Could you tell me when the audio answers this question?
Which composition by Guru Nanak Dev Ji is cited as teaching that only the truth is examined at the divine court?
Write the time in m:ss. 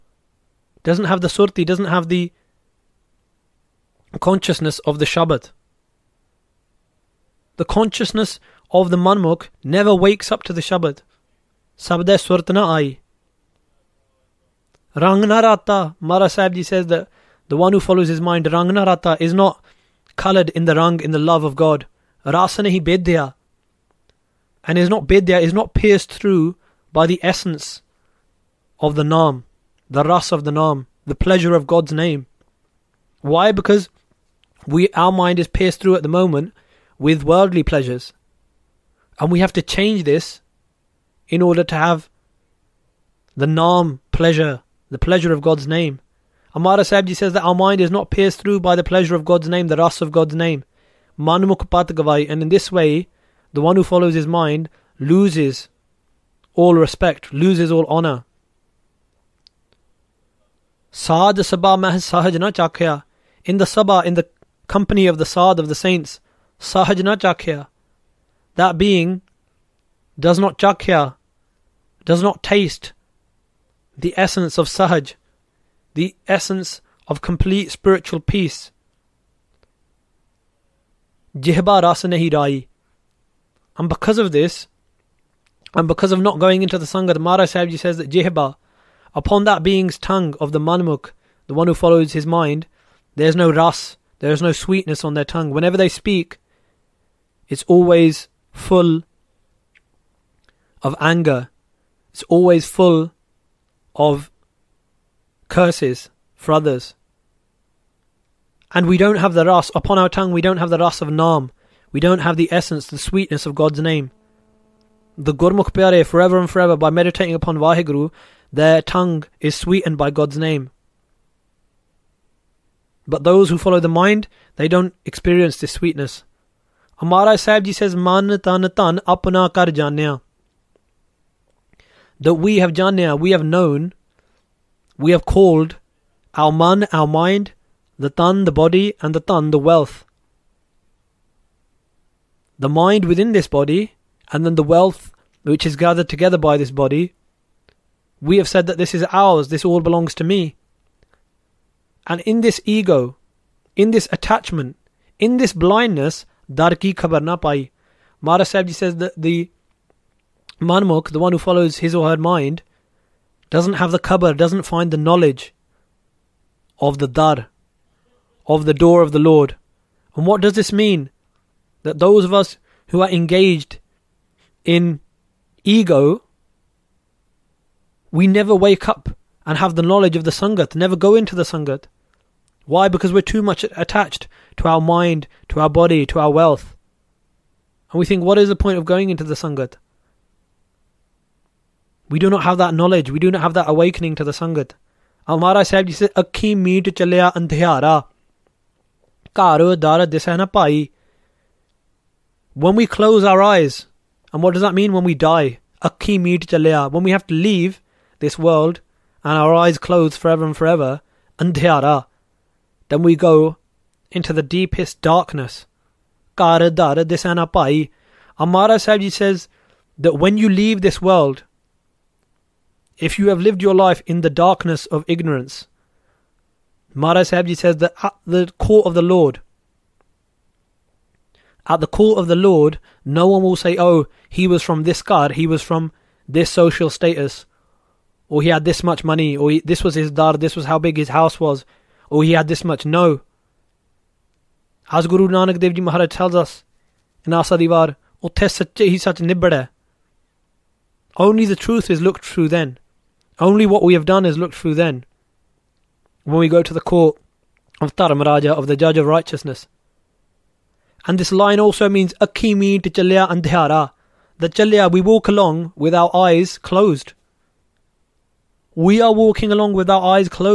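4:07.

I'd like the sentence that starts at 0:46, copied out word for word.
Amara sabji says that our mind is not pierced through by the pleasure of God's name, the ras of God's name.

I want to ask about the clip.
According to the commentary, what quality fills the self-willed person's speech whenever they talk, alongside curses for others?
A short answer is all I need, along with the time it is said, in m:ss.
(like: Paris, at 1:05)
anger, at 1:40.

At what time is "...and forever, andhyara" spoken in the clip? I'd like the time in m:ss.
3:30.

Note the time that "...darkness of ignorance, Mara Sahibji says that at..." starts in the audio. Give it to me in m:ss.
3:44.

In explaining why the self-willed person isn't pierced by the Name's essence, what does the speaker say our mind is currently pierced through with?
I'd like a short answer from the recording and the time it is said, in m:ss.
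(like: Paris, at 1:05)
worldly pleasures, at 0:37.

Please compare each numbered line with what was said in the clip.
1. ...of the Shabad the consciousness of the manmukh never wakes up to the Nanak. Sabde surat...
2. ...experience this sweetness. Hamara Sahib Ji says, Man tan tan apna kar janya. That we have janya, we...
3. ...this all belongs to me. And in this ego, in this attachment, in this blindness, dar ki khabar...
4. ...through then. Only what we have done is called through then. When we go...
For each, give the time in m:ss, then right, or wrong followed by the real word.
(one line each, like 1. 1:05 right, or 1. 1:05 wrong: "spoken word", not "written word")
1. 0:04 wrong: "Shabad", not "Nanak"
2. 2:05 right
3. 2:29 right
4. 4:12 wrong: "looked", not "called".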